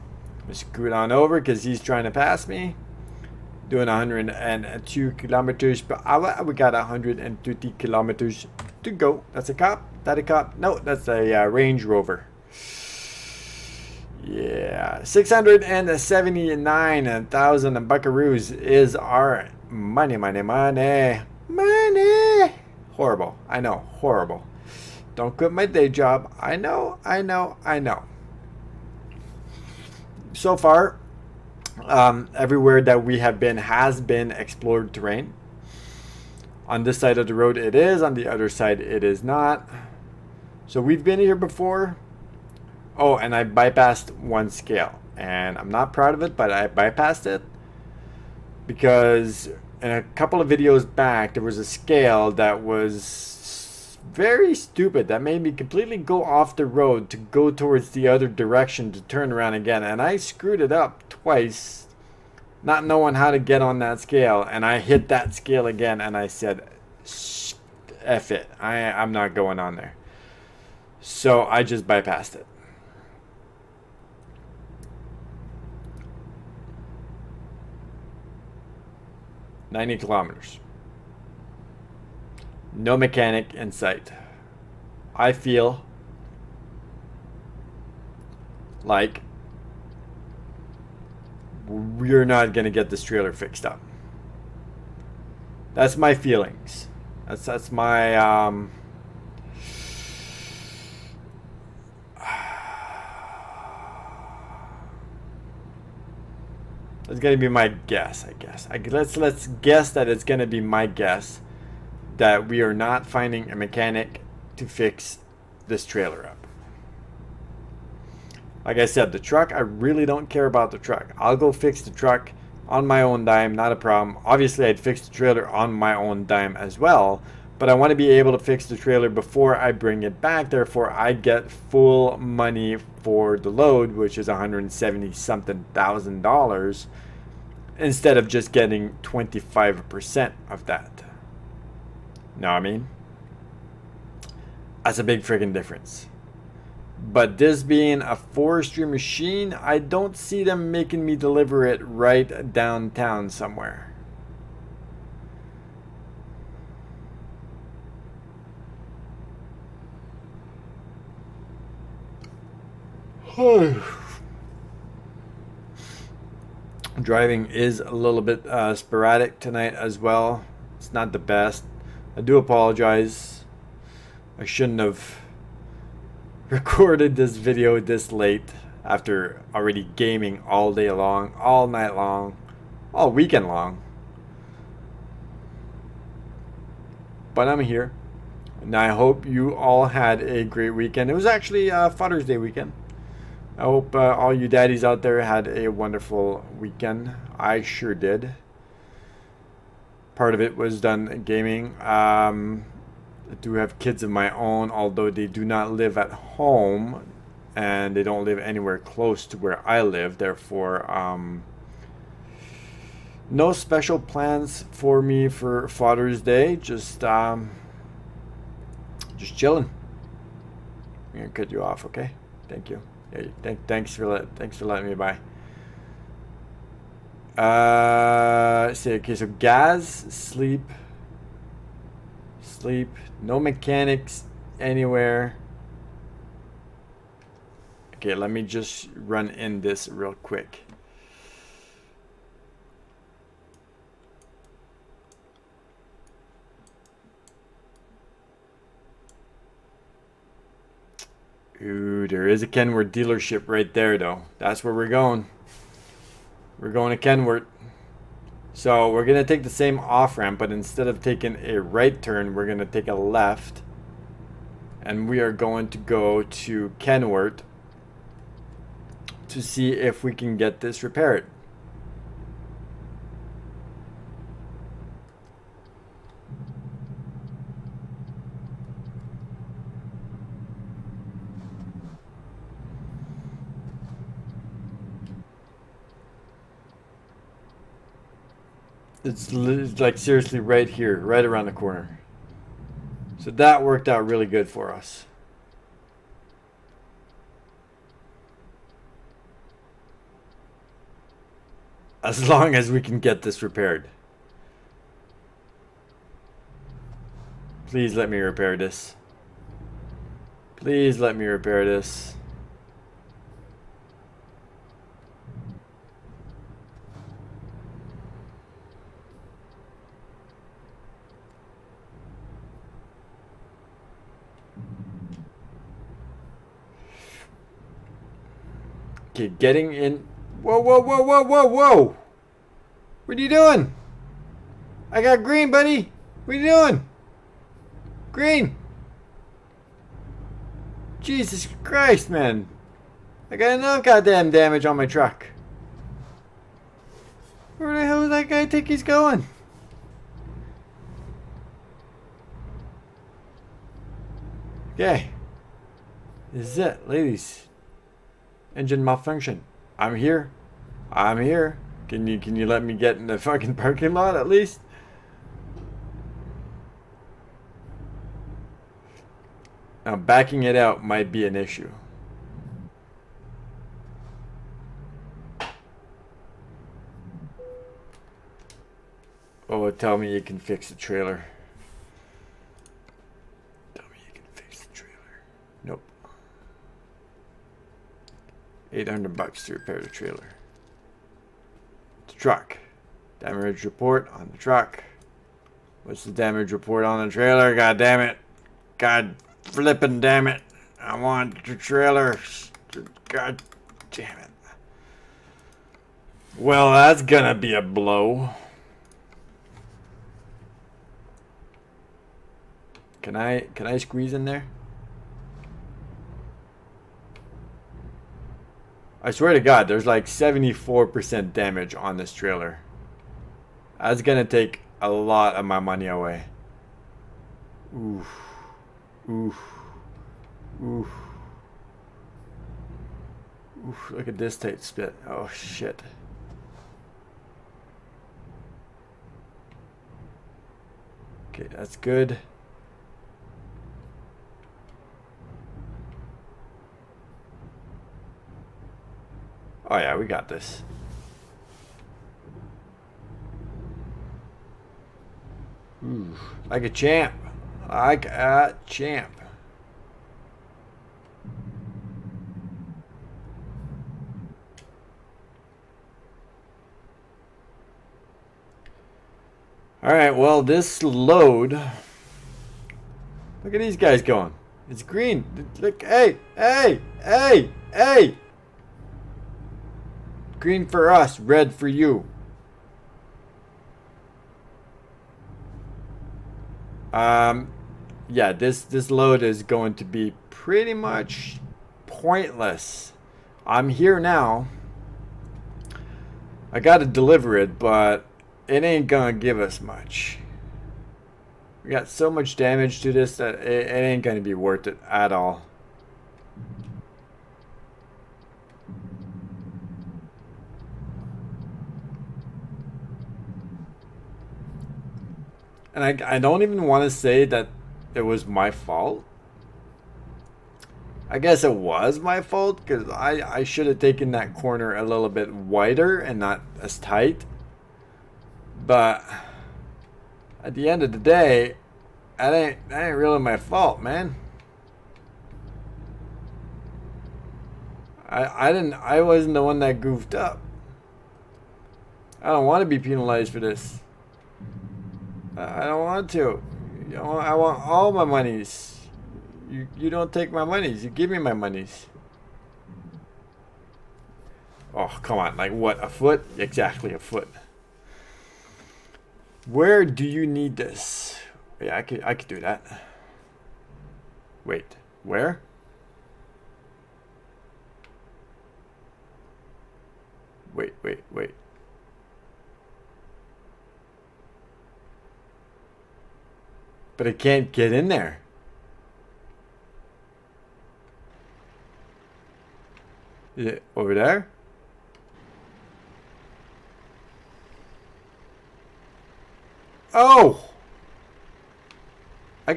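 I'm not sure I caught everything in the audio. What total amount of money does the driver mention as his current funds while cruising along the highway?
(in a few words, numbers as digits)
679,000.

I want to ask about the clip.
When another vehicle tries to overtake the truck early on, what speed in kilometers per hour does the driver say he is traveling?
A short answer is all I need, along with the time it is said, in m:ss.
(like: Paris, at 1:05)
102, at 0:03.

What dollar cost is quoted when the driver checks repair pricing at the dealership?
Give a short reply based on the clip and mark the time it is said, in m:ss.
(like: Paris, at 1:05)
800, at 6:28.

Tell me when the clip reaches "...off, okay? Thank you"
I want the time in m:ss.
3:41.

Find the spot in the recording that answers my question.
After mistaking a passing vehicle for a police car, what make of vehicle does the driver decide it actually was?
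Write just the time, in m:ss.
0:11.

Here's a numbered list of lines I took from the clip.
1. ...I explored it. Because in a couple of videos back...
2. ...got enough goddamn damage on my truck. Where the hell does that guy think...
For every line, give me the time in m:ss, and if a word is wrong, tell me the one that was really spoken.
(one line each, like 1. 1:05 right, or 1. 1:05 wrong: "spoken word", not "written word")
1. 0:46 wrong: "bypassed", not "explored"
2. 5:43 right.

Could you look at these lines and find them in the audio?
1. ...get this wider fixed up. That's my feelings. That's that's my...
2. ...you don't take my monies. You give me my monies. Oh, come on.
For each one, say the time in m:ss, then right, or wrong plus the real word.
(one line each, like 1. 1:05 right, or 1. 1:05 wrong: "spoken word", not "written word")
1. 1:32 wrong: "trailer", not "wider"
2. 9:09 right.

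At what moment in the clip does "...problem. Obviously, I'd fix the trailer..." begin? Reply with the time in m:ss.
2:03.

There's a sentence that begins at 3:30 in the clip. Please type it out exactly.
Therefore, um, no special plans for me for Father's Day.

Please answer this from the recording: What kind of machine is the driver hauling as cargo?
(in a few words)
forestry machine.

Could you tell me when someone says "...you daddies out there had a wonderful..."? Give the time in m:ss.
3:14.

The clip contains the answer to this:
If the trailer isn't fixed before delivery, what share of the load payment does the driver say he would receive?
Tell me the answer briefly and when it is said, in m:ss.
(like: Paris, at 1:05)
25%, at 2:19.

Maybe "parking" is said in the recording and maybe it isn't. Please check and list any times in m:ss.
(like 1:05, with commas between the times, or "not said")
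6:03.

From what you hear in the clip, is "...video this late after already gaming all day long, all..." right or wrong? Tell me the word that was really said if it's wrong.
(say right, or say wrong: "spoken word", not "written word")
right.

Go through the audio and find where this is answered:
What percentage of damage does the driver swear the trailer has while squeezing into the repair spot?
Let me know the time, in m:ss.
7:00.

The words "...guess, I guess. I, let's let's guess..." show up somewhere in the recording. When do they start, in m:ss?
1:47.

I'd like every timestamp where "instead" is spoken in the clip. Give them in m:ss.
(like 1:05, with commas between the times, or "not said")
2:17, 4:20.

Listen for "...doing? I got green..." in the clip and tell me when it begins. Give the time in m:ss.
5:33.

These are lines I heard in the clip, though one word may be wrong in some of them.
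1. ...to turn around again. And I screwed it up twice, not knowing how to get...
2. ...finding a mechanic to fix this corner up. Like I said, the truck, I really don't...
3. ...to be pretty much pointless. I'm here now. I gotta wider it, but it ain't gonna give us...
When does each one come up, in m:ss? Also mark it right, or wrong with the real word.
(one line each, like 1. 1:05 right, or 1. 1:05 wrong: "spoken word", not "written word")
1. 0:58 right
2. 1:53 wrong: "trailer", not "corner"
3. 8:09 wrong: "deliver", not "wider".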